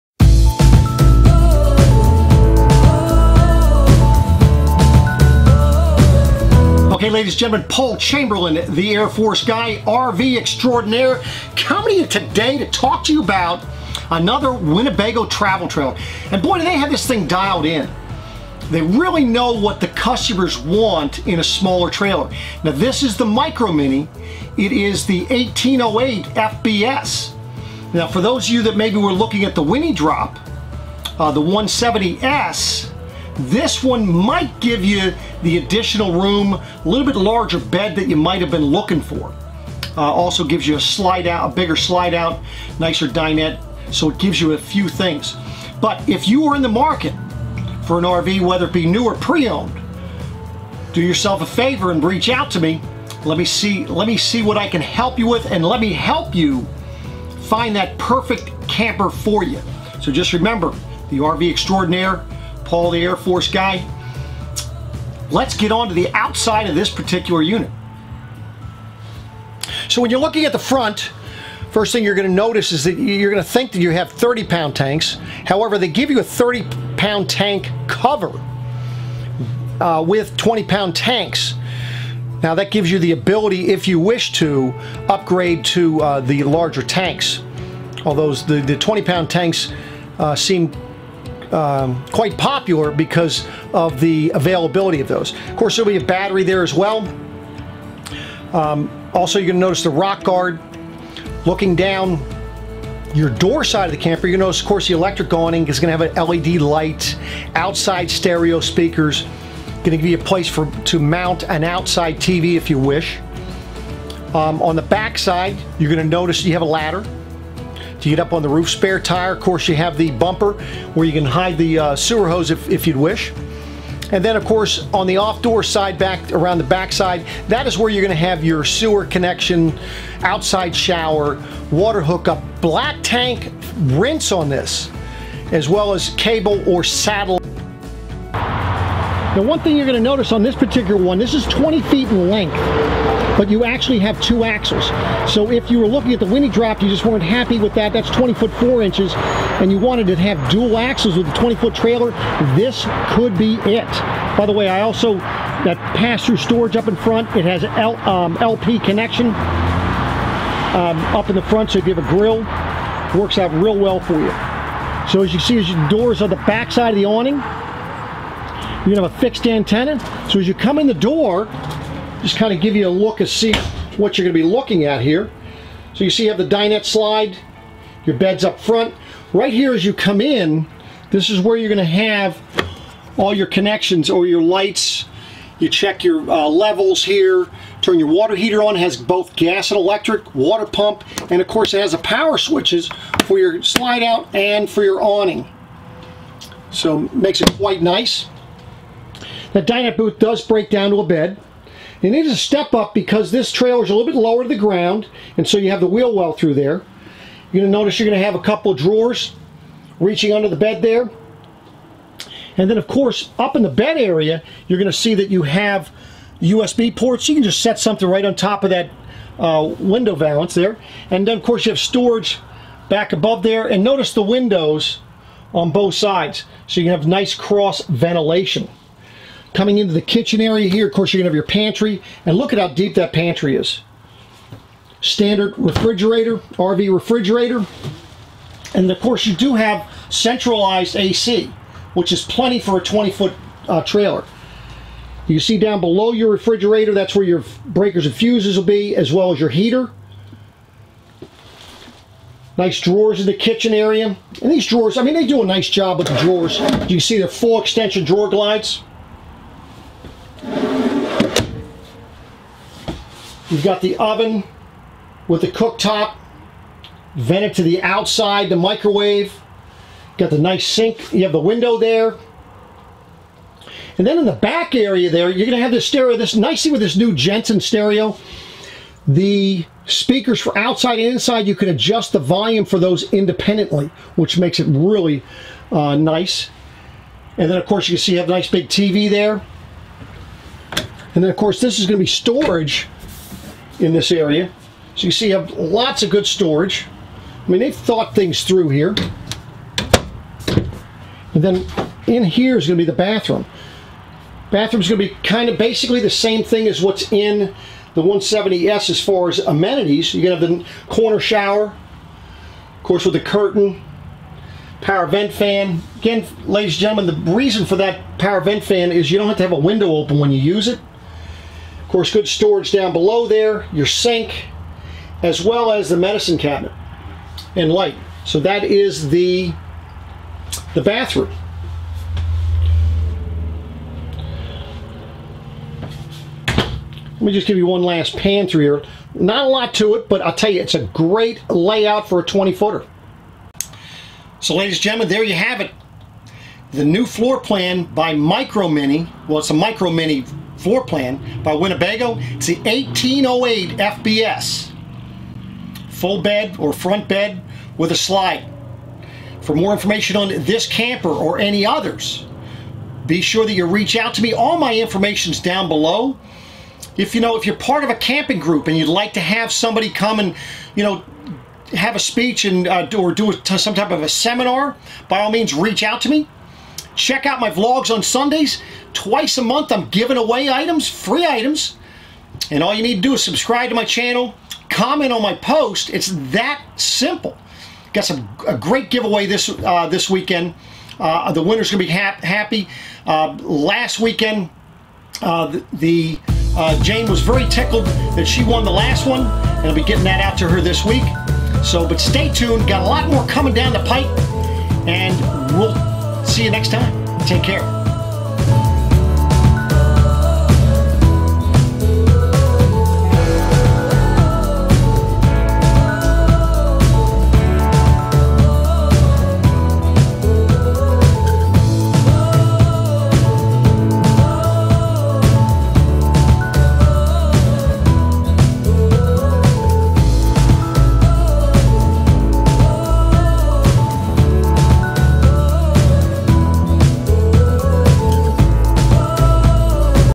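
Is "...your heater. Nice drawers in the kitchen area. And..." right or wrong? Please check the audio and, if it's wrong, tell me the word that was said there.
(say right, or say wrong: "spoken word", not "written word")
right.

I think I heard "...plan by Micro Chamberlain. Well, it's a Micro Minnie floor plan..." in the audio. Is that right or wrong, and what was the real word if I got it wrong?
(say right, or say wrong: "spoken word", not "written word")
wrong: "Minnie", not "Chamberlain".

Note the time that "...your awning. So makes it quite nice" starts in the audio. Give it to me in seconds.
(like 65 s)
194 s.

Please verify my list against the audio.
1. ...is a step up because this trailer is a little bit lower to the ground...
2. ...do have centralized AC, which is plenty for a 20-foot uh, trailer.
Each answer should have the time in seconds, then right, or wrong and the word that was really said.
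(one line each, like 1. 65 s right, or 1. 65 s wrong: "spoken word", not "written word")
1. 202 s right
2. 239 s right.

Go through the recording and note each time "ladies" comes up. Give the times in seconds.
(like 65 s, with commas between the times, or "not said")
7 s, 316 s, 344 s.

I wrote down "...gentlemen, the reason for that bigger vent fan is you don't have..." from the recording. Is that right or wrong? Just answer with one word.
wrong.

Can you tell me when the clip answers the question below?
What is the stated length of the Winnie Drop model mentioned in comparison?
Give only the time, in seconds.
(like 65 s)
148 s.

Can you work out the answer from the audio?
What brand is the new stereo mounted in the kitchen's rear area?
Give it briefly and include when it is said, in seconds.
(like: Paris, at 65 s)
Jensen, at 277 s.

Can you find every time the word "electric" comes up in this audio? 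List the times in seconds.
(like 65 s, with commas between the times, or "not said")
104 s, 189 s.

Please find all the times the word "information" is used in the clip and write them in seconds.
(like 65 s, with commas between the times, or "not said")
359 s, 364 s.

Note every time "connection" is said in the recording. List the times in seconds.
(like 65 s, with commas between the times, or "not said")
129 s, 158 s, 183 s.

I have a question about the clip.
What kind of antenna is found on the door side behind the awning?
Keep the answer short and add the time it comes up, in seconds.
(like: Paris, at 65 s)
Fixed antenna, at 169 s.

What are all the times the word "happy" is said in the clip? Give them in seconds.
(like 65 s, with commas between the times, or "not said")
147 s, 392 s.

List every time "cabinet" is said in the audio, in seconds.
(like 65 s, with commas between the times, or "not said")
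326 s.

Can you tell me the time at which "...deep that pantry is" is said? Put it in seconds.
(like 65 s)
232 s.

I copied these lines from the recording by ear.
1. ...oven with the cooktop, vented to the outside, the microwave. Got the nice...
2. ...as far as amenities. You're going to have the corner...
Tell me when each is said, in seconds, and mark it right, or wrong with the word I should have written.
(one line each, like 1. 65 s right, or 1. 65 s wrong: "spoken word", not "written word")
1. 263 s right
2. 308 s right.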